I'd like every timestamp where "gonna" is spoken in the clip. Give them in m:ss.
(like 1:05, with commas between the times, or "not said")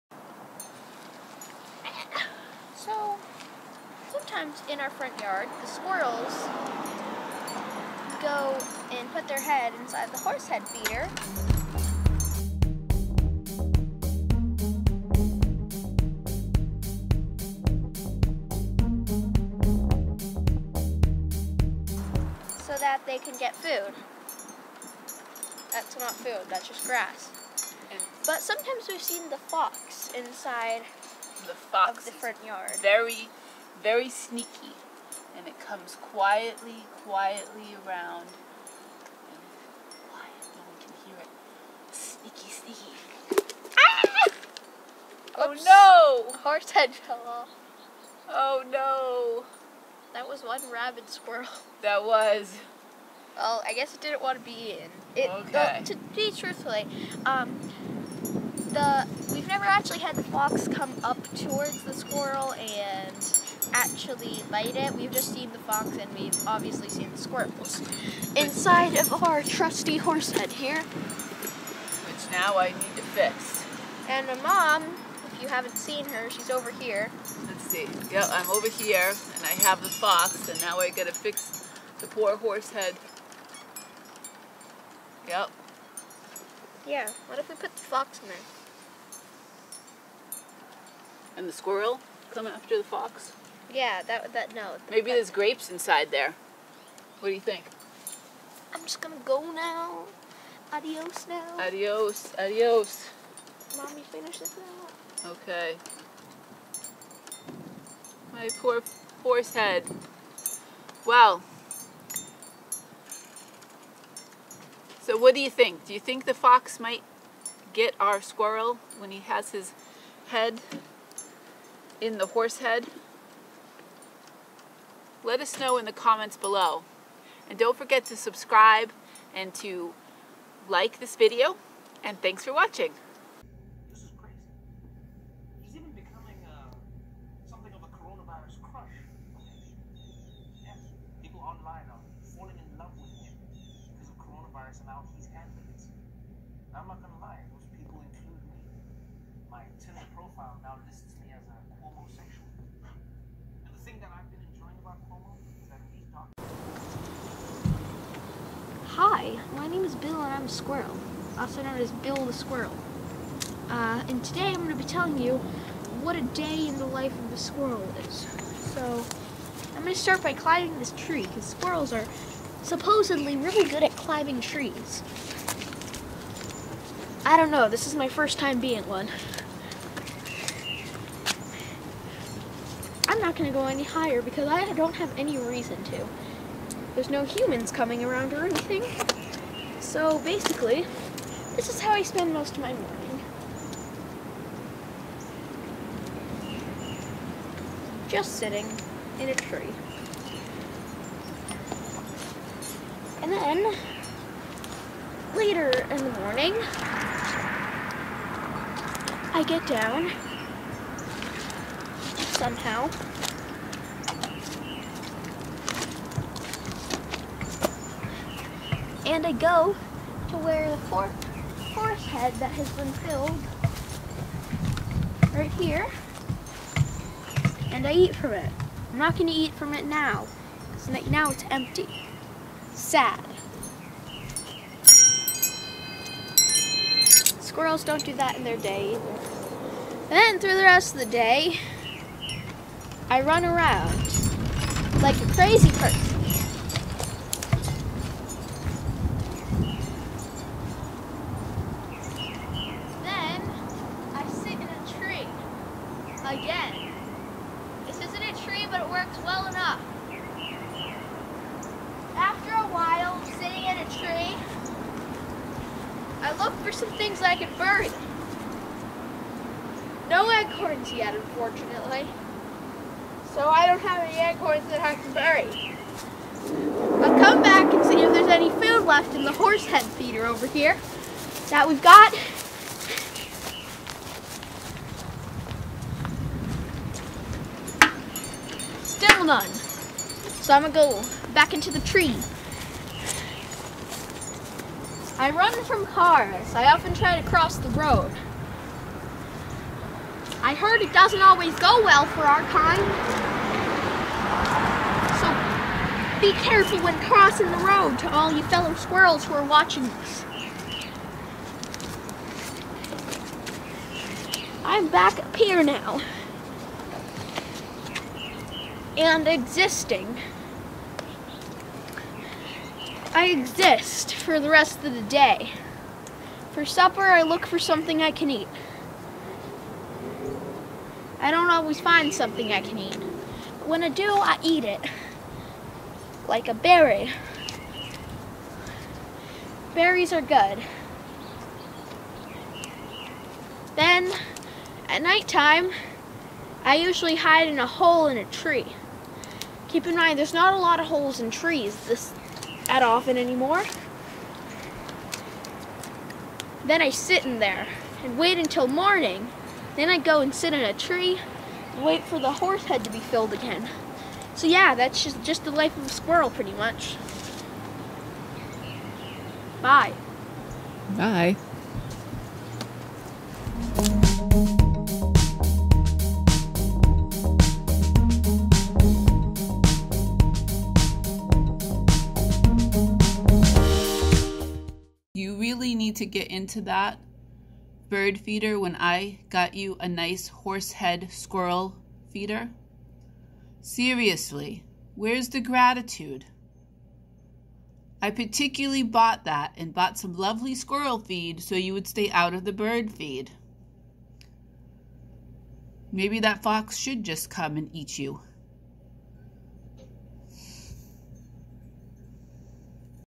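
1:39, 2:26, 4:50.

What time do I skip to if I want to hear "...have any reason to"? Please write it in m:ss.
3:04.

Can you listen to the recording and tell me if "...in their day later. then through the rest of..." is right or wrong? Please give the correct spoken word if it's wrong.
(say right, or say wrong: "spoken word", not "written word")
wrong: "either", not "later".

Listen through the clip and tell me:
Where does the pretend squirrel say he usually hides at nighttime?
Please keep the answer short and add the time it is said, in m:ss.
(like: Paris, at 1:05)
A hole in a tree, at 5:47.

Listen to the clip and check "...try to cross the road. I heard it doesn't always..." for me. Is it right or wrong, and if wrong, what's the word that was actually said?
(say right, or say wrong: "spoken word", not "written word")
right.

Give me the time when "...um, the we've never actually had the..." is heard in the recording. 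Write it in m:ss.
0:57.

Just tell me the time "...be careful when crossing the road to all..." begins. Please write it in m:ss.
5:06.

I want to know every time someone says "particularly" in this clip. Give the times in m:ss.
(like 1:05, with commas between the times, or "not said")
6:38.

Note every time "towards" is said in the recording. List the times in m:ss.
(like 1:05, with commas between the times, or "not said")
1:01.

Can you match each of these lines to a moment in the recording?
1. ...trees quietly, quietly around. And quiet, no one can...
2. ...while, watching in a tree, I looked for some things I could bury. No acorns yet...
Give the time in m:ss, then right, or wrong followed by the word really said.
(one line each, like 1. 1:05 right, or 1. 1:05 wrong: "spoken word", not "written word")
1. 0:35 wrong: "comes", not "trees"
2. 4:22 wrong: "sitting", not "watching".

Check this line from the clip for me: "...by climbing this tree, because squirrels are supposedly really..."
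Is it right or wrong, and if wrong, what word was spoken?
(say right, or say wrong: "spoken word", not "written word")
right.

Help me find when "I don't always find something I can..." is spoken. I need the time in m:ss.
5:31.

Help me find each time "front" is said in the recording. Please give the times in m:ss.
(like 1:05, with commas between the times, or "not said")
0:04, 0:32.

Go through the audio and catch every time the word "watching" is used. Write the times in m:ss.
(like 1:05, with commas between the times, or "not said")
2:12, 5:09.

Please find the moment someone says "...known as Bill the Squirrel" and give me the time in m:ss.
2:41.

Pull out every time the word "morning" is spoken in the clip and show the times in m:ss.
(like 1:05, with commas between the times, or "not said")
3:12, 3:26, 5:58.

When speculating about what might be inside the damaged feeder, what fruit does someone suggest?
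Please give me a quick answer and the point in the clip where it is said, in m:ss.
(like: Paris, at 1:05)
Grapes, at 1:35.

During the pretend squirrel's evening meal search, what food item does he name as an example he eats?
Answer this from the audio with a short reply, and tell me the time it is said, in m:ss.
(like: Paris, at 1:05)
A berry, at 5:36.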